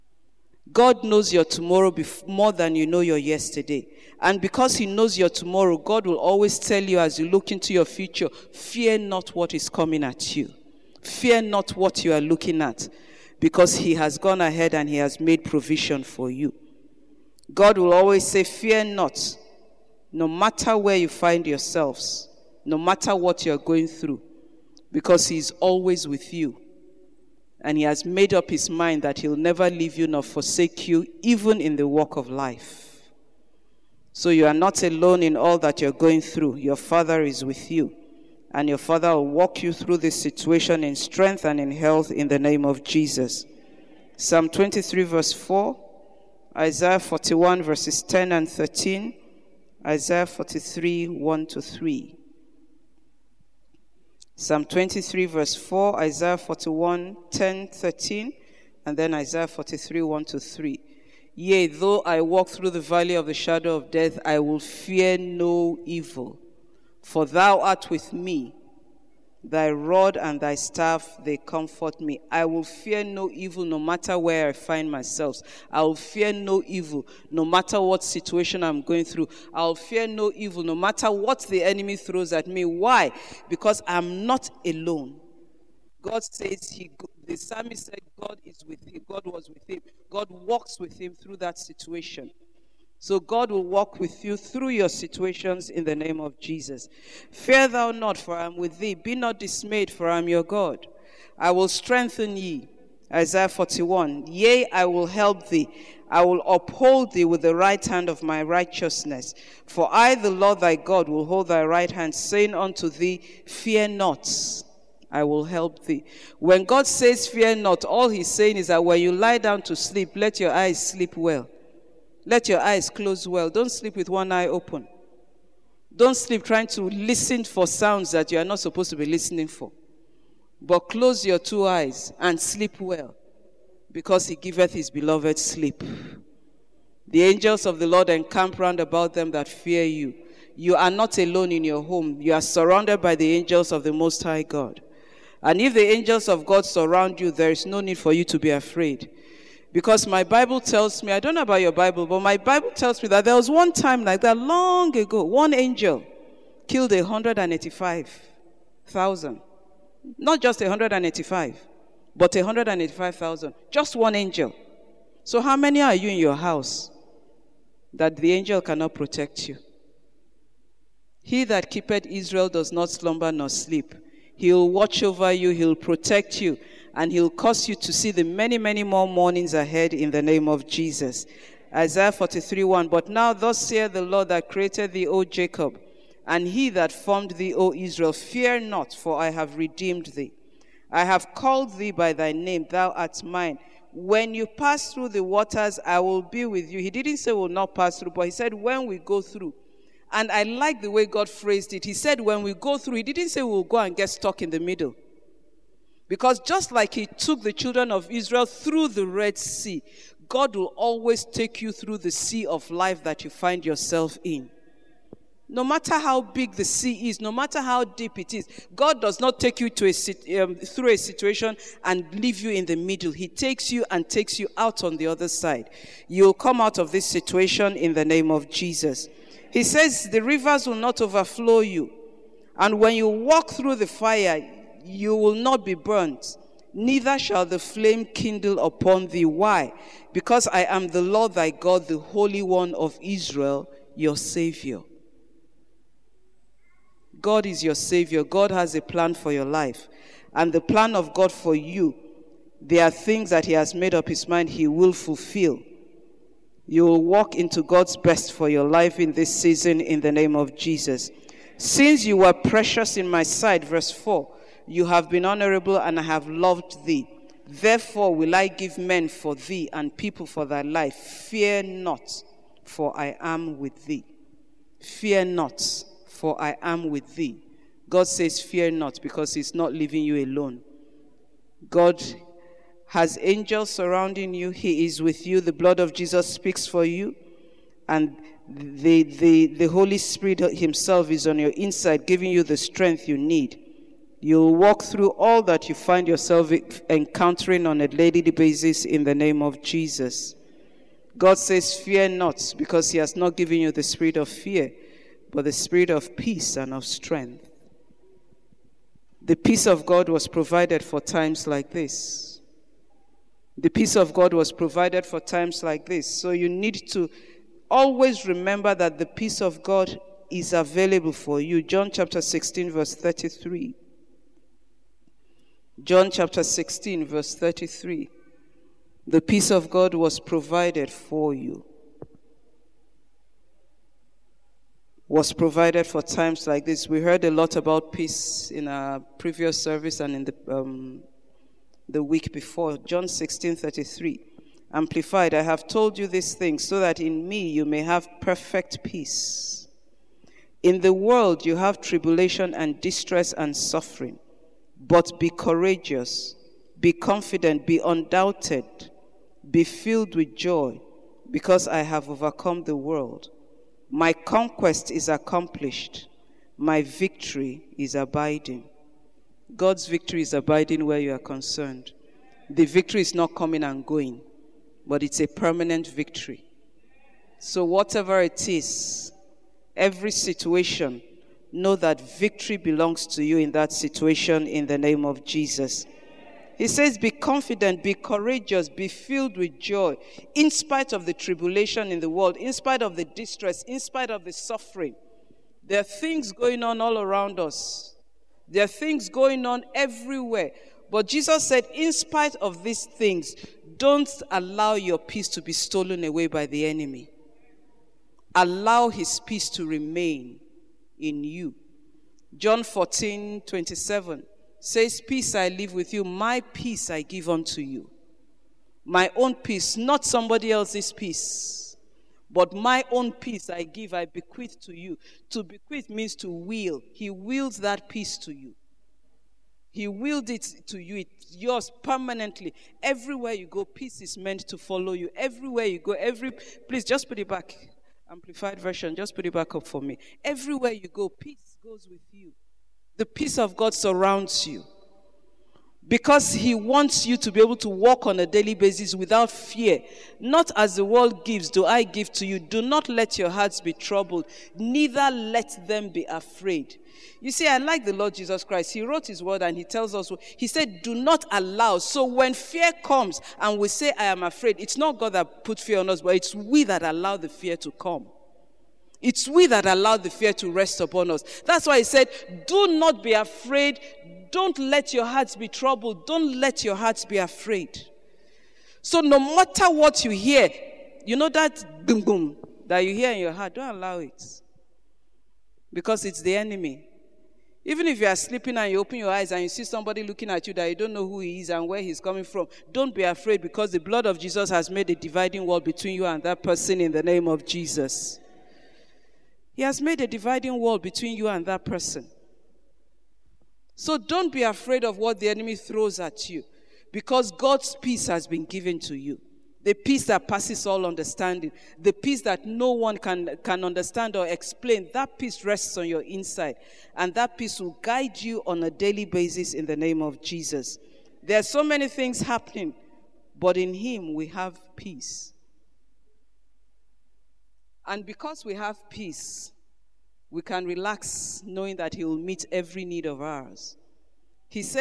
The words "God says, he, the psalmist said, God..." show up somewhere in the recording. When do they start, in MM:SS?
01:26.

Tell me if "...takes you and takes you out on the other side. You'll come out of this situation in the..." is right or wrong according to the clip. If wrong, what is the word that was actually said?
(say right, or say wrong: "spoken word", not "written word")
right.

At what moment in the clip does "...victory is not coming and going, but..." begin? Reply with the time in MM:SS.
06:12.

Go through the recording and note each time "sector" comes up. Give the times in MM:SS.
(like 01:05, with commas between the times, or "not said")
not said.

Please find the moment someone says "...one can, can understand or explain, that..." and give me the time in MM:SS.
08:32.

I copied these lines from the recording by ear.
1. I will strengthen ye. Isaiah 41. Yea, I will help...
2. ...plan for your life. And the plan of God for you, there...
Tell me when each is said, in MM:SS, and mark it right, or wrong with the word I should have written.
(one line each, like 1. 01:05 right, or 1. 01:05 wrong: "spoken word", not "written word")
1. 01:41 right
2. 04:08 right.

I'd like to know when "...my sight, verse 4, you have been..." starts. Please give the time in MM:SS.
04:23.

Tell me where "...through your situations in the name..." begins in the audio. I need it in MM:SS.
01:34.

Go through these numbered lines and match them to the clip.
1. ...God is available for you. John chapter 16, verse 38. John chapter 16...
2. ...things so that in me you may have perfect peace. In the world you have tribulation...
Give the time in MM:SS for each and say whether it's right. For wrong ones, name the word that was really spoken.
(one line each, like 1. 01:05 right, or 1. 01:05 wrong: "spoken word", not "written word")
1. 05:19 wrong: "33", not "38"
2. 05:46 right.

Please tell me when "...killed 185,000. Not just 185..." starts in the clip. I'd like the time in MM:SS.
02:36.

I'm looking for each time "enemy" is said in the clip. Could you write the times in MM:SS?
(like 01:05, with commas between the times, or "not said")
01:21, 06:46, 08:06, 08:25.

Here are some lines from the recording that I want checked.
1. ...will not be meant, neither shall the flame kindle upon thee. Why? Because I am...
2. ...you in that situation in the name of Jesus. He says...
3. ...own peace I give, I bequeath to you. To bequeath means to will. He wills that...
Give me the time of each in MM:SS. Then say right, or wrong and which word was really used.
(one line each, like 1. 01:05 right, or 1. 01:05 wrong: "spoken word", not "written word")
1. 03:55 wrong: "burnt", not "meant"
2. 06:23 right
3. 07:02 right.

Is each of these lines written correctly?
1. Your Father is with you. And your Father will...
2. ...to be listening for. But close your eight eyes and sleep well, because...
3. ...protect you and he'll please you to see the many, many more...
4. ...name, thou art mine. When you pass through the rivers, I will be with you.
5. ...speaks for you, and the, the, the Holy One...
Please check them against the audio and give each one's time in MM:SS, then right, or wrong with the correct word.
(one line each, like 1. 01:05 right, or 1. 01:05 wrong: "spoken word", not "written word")
1. 00:36 right
2. 02:08 wrong: "two", not "eight"
3. 02:55 wrong: "cause", not "please"
4. 03:12 wrong: "waters", not "rivers"
5. 04:46 wrong: "Spirit", not "One".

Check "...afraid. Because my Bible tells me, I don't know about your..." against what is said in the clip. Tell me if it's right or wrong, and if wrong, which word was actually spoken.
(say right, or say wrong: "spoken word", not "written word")
right.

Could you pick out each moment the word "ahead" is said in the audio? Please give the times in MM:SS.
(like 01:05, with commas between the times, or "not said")
00:14, 02:59.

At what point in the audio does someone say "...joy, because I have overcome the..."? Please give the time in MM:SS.
06:00.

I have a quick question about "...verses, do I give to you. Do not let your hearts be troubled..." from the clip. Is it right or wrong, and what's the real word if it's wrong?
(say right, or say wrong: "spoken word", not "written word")
wrong: "gives", not "verses".